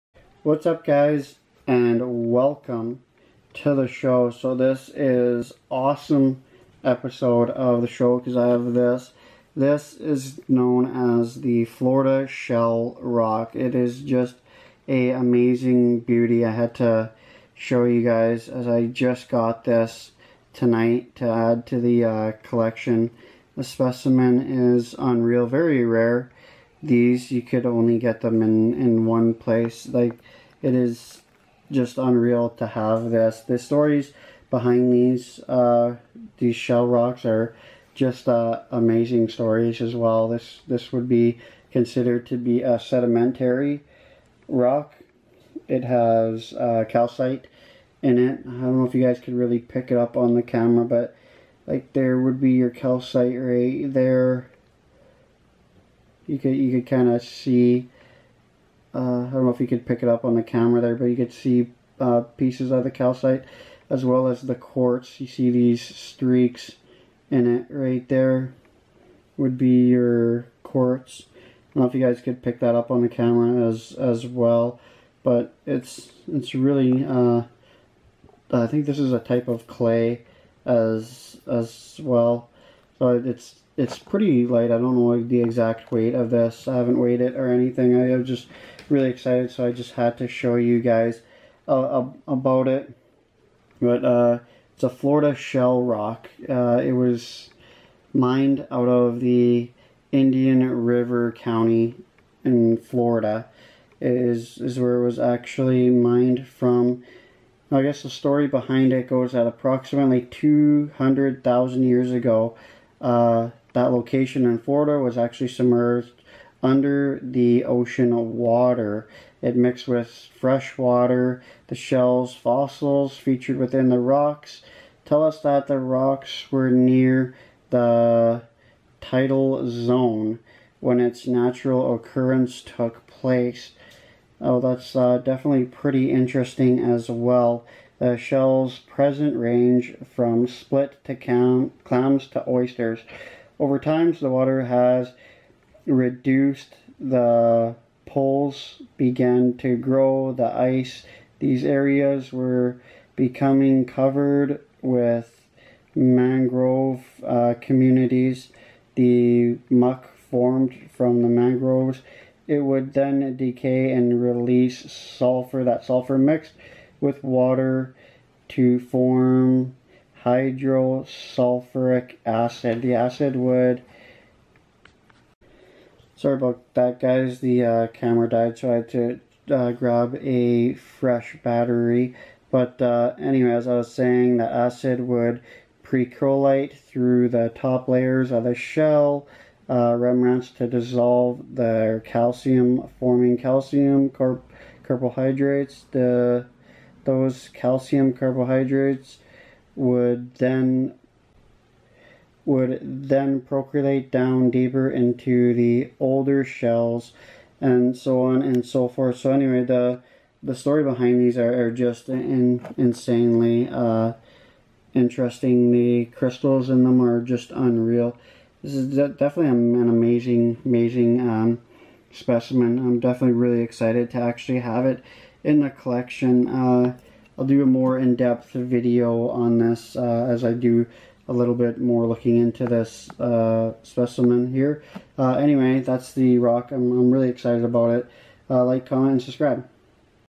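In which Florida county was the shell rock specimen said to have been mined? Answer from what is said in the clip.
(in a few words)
Indian River County.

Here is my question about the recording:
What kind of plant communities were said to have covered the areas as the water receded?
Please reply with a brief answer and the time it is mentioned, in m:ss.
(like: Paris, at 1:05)
mangrove, at 2:35.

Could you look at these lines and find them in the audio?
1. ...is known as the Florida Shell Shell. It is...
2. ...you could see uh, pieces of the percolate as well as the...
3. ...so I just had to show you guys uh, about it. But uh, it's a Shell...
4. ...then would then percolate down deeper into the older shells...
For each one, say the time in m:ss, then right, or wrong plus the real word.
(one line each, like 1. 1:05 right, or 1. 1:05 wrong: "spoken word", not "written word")
1. 0:09 wrong: "Rock", not "Shell"
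2. 1:01 wrong: "calcite", not "percolate"
3. 1:29 wrong: "Florida", not "Shell"
4. 3:20 right.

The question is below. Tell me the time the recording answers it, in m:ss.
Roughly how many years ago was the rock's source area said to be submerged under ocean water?
1:50.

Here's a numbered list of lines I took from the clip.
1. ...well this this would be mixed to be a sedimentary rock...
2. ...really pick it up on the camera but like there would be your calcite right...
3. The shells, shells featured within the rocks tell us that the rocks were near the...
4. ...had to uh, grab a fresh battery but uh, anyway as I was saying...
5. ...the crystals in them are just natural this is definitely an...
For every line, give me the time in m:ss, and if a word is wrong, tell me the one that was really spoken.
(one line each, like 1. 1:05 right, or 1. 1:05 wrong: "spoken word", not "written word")
1. 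0:39 wrong: "considered", not "mixed"
2. 0:49 right
3. 2:01 wrong: "fossils", not "shells"
4. 2:58 right
5. 3:35 wrong: "unreal", not "natural".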